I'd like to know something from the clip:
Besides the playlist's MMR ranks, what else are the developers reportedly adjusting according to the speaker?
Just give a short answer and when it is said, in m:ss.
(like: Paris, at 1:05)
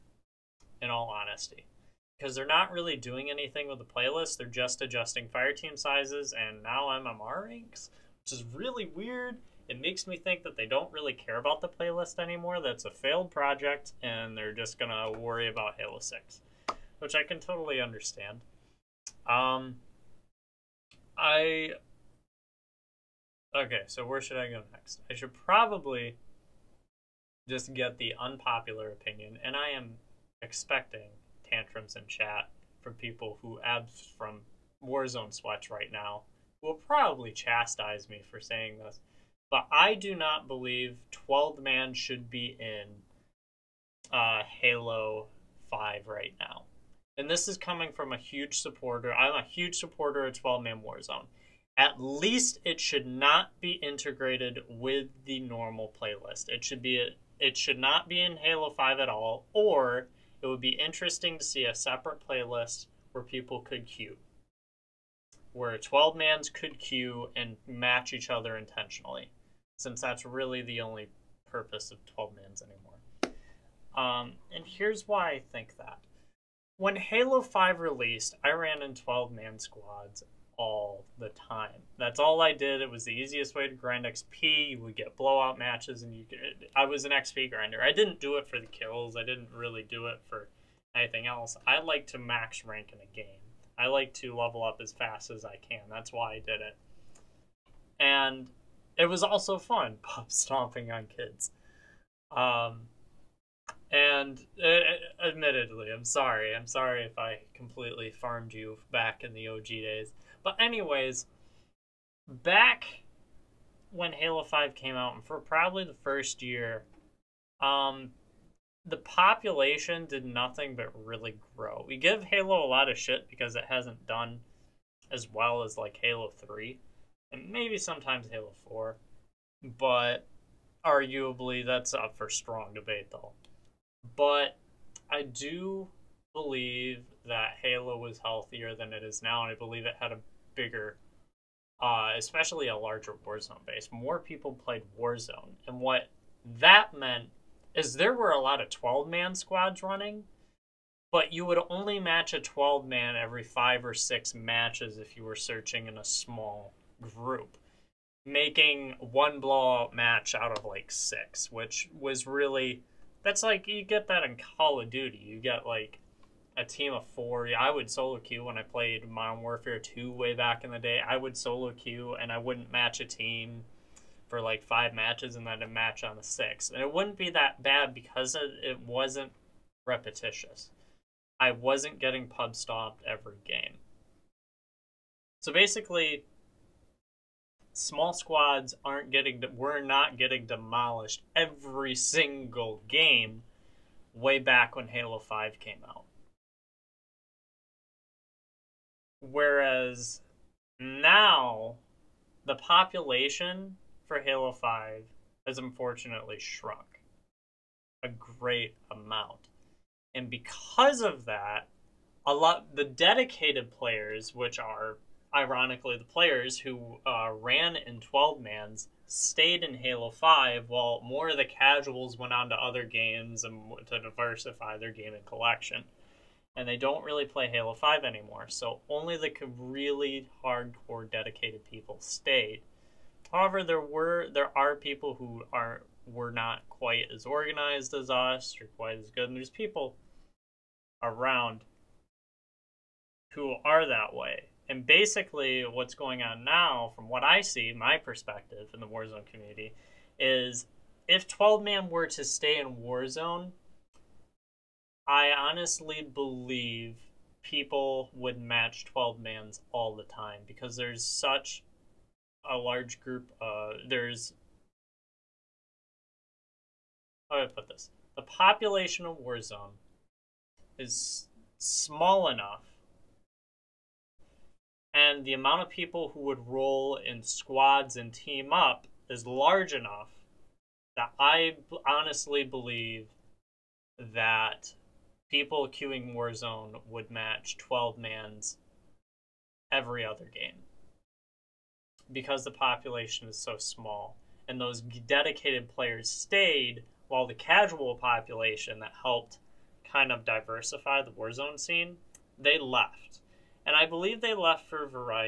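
Fireteam sizes, at 0:05.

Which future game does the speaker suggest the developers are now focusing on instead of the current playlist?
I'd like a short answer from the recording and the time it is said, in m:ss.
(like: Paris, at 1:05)
Halo 6, at 0:15.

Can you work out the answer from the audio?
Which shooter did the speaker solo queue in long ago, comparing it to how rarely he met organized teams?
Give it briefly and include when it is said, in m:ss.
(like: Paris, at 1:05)
Modern Warfare 2, at 2:49.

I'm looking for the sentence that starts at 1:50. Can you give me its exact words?
But, anyways, back when Halo 5 came out, and for probably the first year, um, the population did nothing but really grow.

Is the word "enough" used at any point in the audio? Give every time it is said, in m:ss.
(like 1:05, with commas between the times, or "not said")
4:32, 4:39.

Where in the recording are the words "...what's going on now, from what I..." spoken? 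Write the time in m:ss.
4:05.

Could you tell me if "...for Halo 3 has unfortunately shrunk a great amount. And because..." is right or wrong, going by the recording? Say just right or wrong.
wrong.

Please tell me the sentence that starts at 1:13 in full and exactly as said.
Um, and here's why I think that when Halo 5 released, I ran in 12 man squads all the time.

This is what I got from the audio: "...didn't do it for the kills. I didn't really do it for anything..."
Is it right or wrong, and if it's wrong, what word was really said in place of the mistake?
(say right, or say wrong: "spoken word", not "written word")
right.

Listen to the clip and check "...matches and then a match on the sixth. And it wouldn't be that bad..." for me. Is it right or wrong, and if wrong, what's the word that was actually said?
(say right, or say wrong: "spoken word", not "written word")
right.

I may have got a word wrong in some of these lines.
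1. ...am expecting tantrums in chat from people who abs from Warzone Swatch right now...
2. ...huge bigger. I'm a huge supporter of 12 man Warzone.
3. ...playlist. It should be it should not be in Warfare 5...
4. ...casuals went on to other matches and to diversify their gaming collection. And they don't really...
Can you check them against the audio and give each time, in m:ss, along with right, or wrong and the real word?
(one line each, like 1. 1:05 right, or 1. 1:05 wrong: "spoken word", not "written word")
1. 0:29 right
2. 0:48 wrong: "supporter", not "bigger"
3. 0:56 wrong: "Halo", not "Warfare"
4. 3:41 wrong: "games", not "matches".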